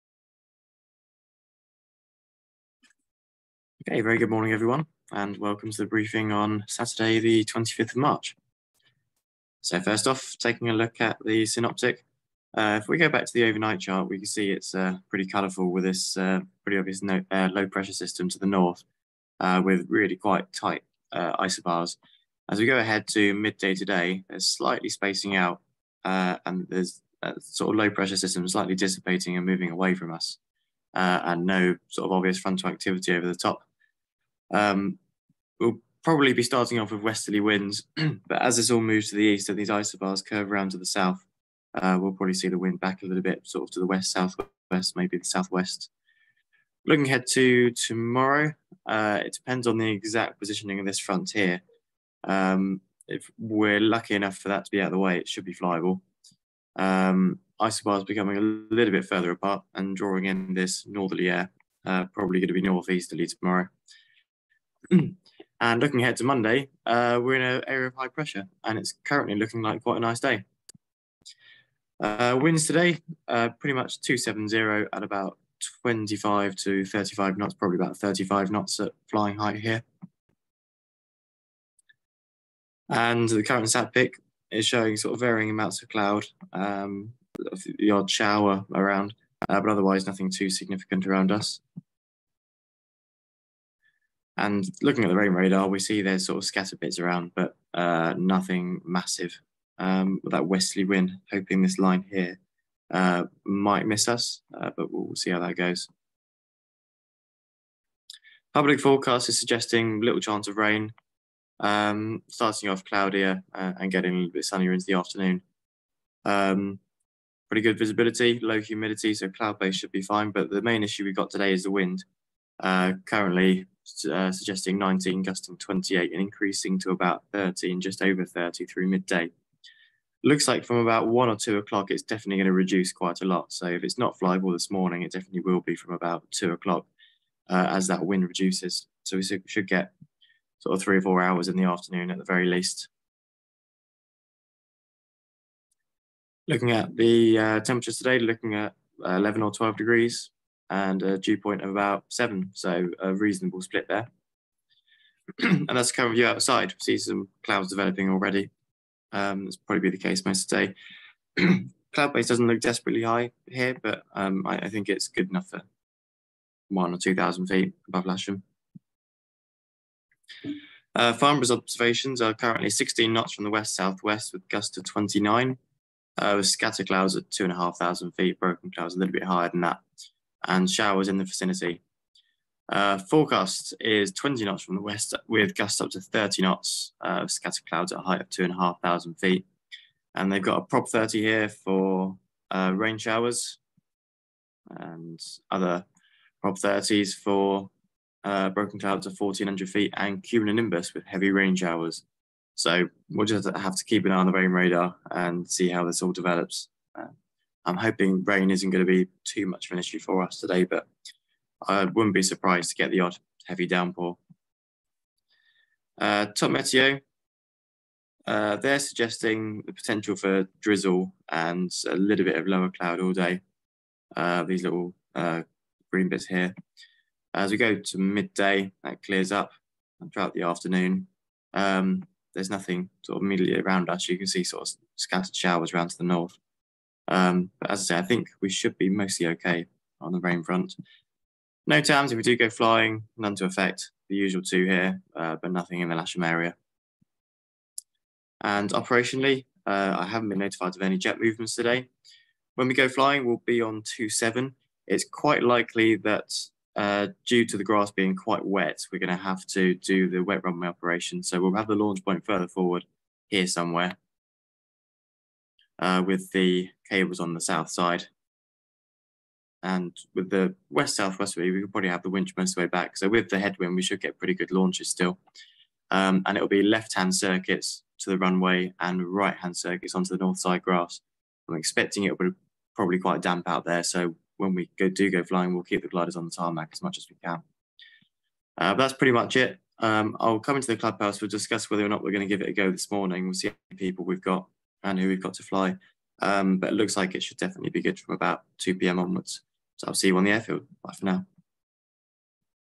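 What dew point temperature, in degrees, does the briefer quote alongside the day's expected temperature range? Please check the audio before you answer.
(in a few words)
7.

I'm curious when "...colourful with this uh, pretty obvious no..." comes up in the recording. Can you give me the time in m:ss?
0:15.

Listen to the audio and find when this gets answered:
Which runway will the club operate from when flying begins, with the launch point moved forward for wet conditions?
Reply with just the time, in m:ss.
4:13.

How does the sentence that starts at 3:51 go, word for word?
Um, there's nothing sort of immediately around us.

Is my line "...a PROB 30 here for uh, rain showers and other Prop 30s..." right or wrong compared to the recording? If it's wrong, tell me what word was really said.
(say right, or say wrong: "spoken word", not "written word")
right.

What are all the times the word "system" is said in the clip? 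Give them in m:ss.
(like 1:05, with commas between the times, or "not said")
0:17, 0:28.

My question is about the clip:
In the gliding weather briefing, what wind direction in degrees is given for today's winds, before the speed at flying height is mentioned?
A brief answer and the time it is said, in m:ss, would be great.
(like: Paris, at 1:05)
270, at 1:14.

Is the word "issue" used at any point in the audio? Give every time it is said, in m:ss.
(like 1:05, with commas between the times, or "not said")
2:00, 3:29.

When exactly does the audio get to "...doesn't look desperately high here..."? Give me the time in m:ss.
2:42.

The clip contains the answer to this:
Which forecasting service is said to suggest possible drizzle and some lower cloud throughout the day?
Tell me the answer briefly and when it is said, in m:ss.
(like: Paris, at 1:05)
TopMeteo, at 3:36.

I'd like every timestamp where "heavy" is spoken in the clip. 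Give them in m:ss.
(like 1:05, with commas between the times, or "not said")
3:21, 3:33.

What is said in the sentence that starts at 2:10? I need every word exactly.
Looks like from about one or two o'clock, it's definitely going to reduce quite a lot.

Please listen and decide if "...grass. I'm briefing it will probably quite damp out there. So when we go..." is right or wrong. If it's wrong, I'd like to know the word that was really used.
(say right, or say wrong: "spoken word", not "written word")
wrong: "expecting", not "briefing".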